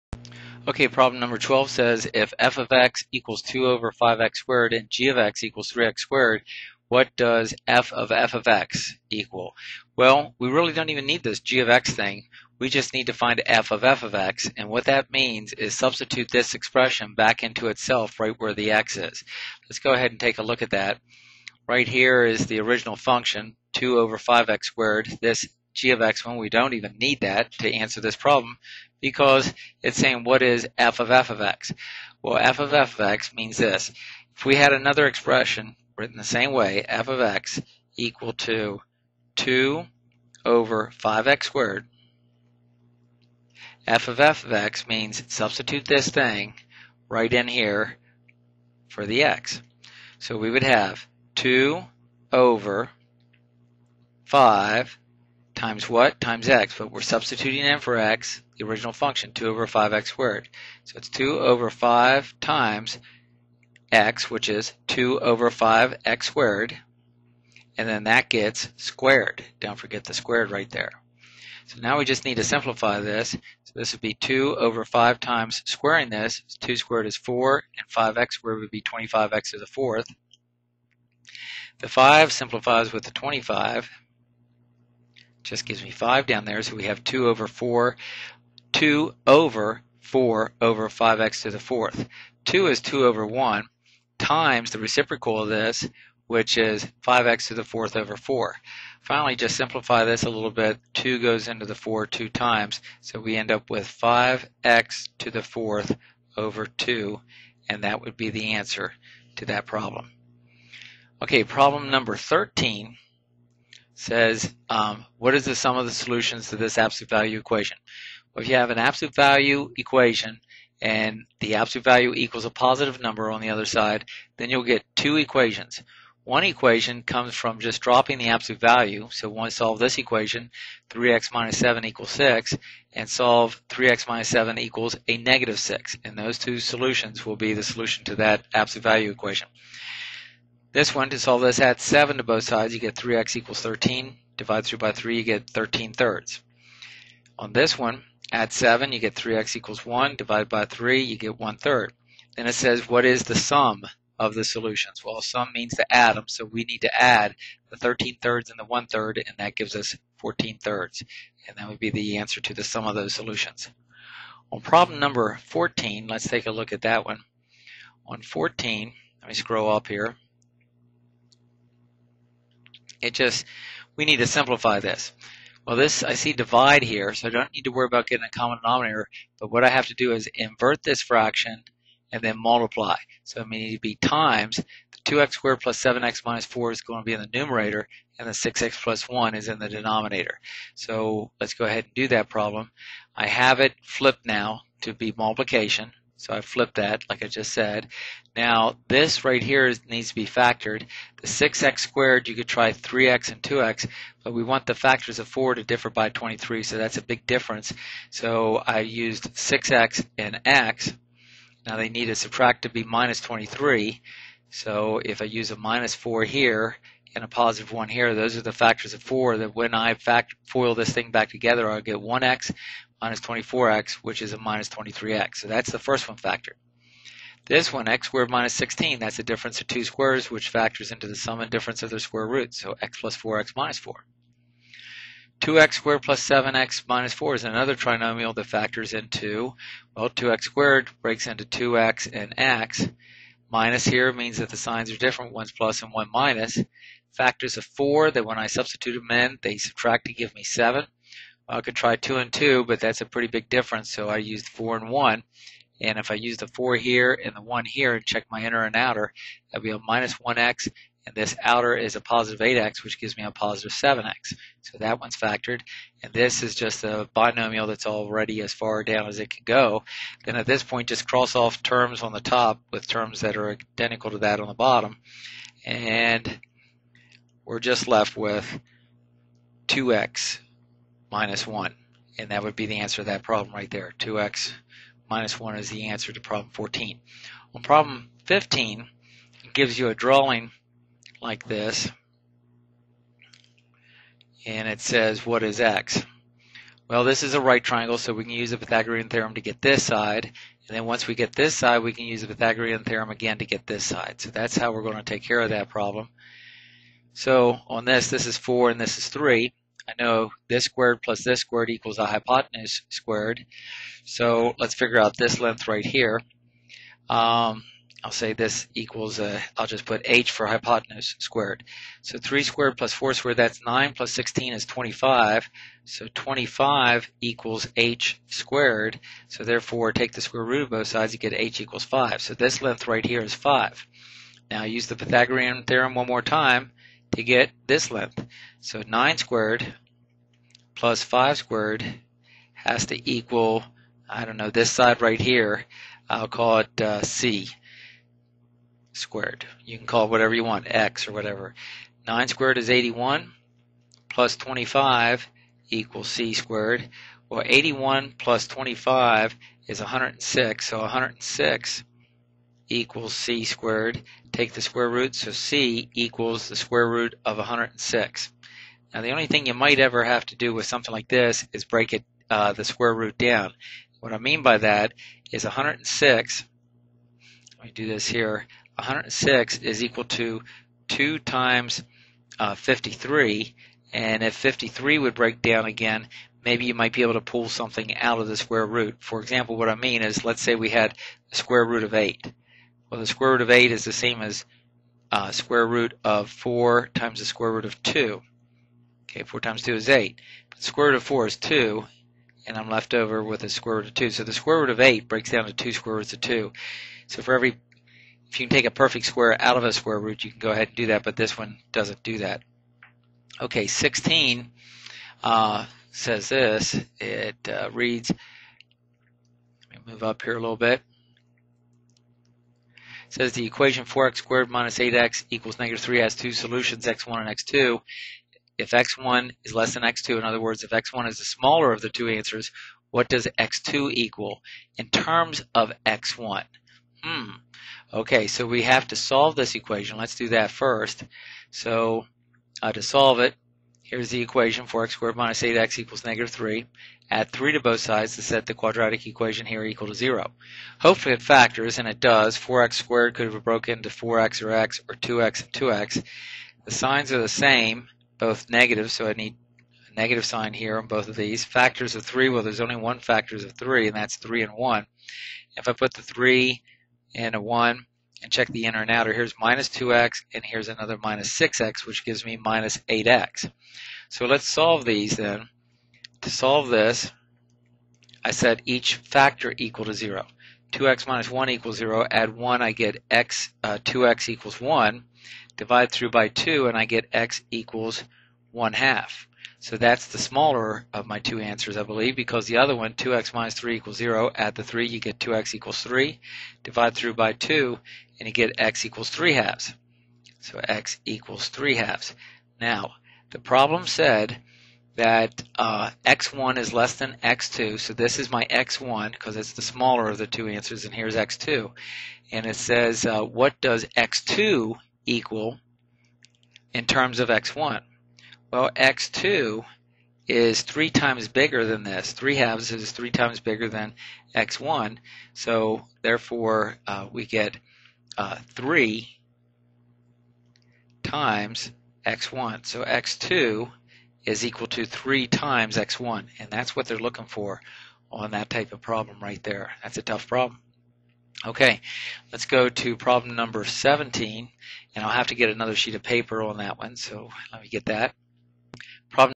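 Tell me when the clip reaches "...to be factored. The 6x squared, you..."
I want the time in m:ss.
3:20.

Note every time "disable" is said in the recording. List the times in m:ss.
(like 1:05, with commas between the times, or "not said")
not said.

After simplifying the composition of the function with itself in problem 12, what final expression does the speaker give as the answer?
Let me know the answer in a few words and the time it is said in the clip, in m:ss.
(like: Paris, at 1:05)
5x^4/2, at 1:43.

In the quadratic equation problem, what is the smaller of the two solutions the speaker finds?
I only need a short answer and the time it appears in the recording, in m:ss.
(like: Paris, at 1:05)
1/2, at 8:08.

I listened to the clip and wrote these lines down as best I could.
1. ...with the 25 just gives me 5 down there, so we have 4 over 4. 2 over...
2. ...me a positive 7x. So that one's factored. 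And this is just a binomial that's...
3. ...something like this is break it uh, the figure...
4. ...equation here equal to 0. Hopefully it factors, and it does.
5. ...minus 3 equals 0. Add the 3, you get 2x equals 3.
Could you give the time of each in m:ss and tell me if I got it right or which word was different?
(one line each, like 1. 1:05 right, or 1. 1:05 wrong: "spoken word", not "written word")
1. 1:22 wrong: "2", not "4"
2. 4:23 right
3. 6:10 wrong: "square", not "figure"
4. 7:29 right
5. 8:13 right.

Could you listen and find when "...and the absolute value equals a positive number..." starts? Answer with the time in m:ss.
2:00.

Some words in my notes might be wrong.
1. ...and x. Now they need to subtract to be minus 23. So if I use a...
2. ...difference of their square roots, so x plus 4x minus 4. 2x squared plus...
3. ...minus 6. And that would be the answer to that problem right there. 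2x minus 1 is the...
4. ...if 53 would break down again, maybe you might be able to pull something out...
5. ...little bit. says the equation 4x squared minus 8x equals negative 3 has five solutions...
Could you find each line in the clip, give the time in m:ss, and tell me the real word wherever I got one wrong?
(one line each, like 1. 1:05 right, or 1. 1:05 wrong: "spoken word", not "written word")
1. 3:30 right
2. 3:51 right
3. 4:41 wrong: "1", not "6"
4. 6:24 right
5. 7:00 wrong: "two", not "five".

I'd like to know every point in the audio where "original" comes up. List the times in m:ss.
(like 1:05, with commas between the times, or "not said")
0:22, 0:58.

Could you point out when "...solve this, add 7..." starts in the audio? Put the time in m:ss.
2:21.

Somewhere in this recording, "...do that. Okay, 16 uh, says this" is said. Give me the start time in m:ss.
6:52.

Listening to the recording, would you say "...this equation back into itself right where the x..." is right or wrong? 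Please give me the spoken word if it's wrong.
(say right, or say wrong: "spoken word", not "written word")
wrong: "expression", not "equation".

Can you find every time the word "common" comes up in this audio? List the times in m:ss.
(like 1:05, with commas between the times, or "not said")
2:58.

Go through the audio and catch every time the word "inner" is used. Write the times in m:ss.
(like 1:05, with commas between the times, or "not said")
4:18, 7:48.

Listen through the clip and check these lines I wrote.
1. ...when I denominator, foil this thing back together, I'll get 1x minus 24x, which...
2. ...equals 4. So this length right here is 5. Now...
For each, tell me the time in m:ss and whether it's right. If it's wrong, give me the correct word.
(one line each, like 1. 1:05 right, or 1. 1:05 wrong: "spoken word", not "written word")
1. 3:39 wrong: "factor", not "denominator"
2. 5:31 wrong: "5", not "4".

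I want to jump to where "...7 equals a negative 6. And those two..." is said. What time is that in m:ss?
2:14.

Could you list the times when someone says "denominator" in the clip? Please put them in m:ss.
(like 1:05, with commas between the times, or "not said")
2:58, 3:09.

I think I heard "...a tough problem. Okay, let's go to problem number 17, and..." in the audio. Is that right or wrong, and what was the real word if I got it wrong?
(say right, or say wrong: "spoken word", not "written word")
right.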